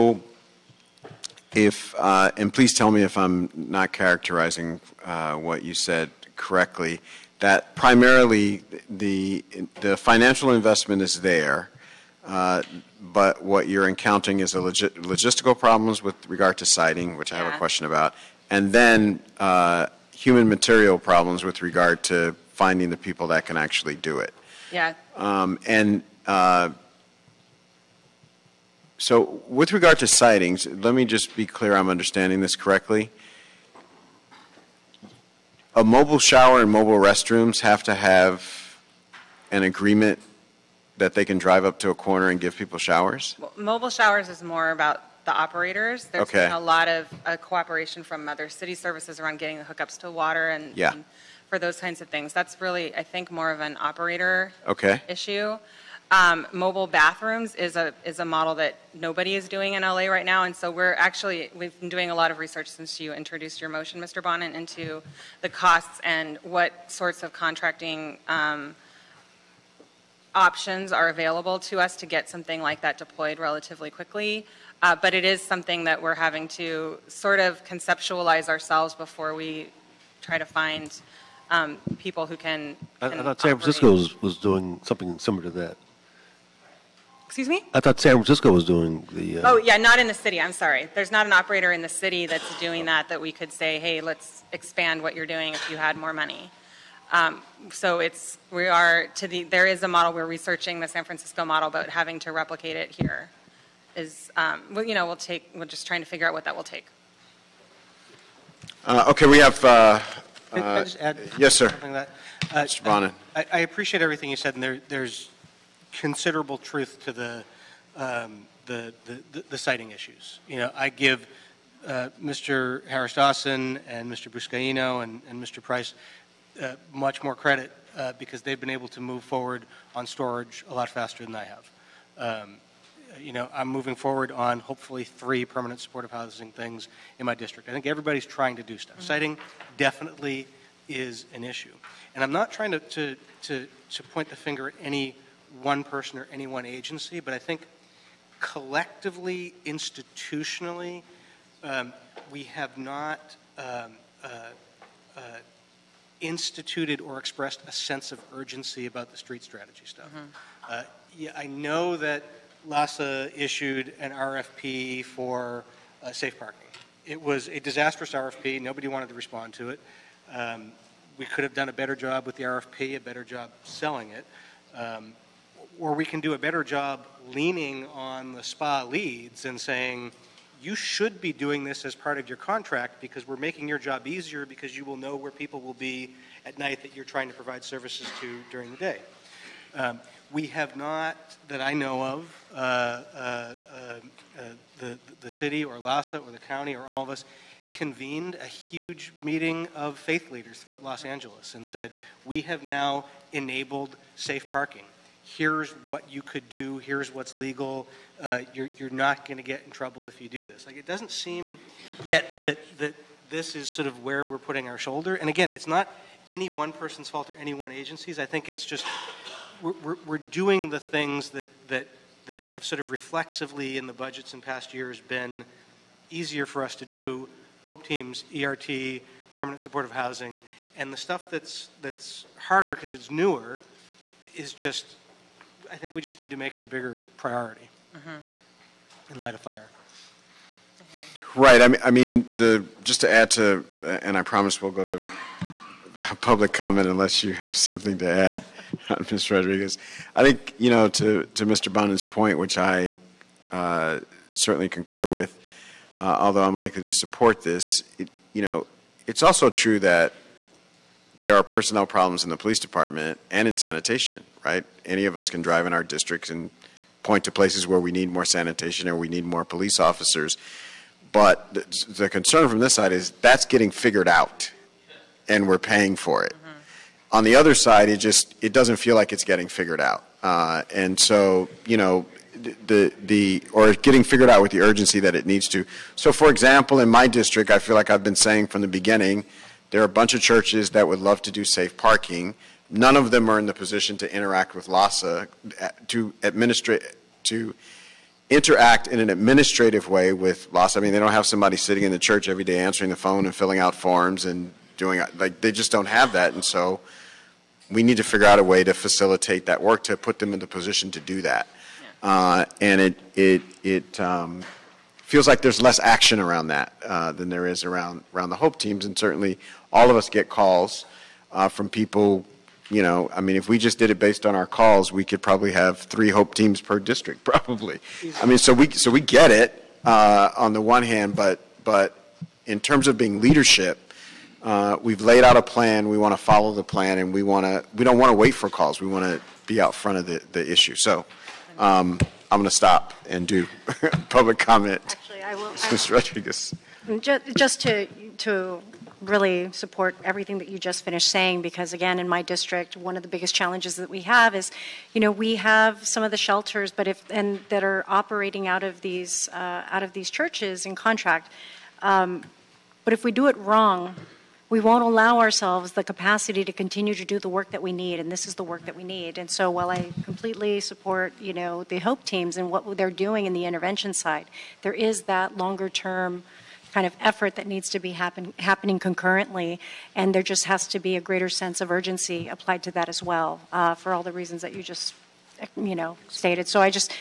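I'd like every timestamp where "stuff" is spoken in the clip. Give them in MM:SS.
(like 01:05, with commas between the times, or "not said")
02:18, 02:39, 03:50.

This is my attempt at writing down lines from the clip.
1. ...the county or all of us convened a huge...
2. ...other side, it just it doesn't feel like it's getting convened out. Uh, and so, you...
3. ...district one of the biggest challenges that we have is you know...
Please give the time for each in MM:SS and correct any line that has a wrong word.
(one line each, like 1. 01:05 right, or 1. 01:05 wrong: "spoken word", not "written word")
1. 03:16 right
2. 04:37 wrong: "figured", not "convened"
3. 05:52 right.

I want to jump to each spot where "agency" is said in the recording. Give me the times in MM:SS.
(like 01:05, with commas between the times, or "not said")
02:26, 03:37.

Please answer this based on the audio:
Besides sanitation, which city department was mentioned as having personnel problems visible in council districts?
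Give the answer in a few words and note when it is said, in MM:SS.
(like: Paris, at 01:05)
Police department, at 04:22.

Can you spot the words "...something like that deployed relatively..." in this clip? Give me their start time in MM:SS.
01:12.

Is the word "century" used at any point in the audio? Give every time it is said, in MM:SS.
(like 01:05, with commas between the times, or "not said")
not said.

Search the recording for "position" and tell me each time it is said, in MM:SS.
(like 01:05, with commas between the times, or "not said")
04:53, 05:10.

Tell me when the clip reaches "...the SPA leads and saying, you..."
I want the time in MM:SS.
02:58.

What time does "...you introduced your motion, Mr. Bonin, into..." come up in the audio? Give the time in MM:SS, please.
01:02.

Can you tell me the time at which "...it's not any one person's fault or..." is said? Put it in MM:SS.
03:35.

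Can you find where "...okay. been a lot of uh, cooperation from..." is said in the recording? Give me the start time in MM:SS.
00:46.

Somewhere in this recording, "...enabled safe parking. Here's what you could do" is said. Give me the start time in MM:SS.
03:23.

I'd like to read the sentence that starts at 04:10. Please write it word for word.
I think, you know, to, to Mr.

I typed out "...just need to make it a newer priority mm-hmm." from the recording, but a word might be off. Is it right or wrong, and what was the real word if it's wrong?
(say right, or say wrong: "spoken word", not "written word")
wrong: "bigger", not "newer".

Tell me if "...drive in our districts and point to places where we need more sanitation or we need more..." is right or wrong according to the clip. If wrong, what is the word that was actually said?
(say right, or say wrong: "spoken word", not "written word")
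right.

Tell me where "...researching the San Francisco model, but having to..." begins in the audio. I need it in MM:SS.
01:40.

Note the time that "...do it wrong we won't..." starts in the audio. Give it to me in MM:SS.
06:03.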